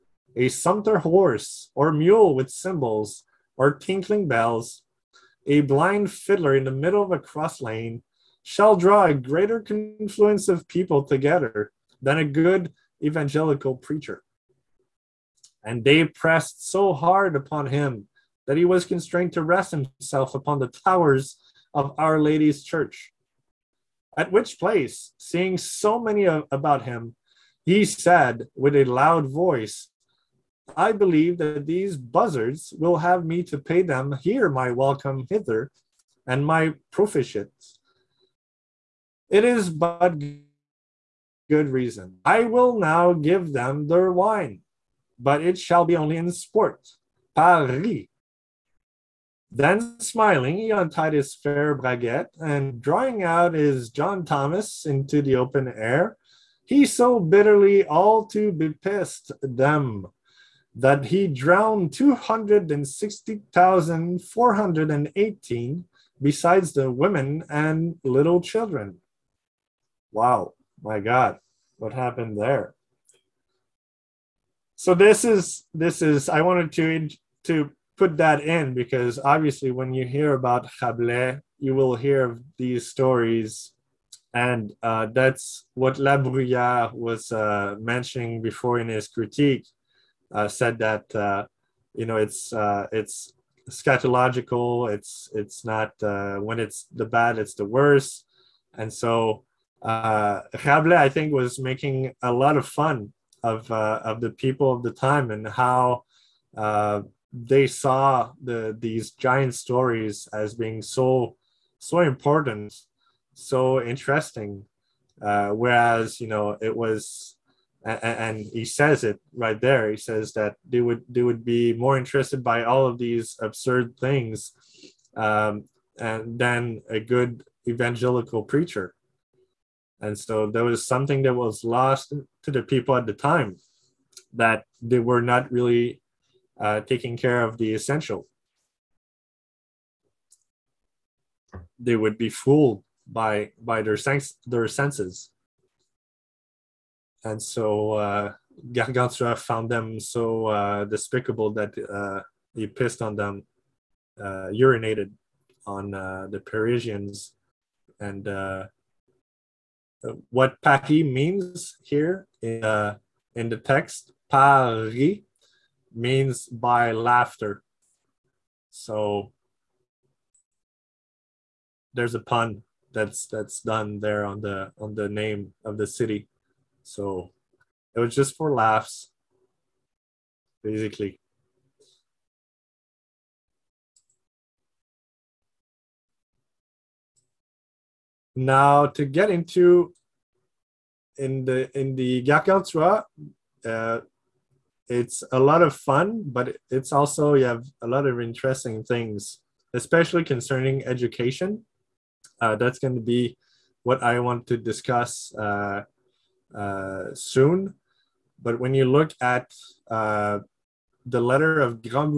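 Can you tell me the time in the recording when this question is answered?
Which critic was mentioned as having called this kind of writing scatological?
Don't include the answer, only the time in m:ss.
1:25.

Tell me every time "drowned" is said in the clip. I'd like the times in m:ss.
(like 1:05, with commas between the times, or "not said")
1:01.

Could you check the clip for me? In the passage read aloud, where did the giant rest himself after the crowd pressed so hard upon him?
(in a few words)
Towers of Our Lady's church.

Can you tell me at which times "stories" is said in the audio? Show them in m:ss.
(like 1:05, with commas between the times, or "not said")
1:22, 1:49.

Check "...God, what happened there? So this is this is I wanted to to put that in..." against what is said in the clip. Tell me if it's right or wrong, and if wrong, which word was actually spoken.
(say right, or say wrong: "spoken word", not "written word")
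right.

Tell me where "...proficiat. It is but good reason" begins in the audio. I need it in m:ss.
0:36.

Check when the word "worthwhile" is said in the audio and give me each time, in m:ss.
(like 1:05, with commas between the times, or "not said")
not said.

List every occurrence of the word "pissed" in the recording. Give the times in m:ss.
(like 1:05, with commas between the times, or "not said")
0:58, 2:32.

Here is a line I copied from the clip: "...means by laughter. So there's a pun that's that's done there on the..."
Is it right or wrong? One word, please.
right.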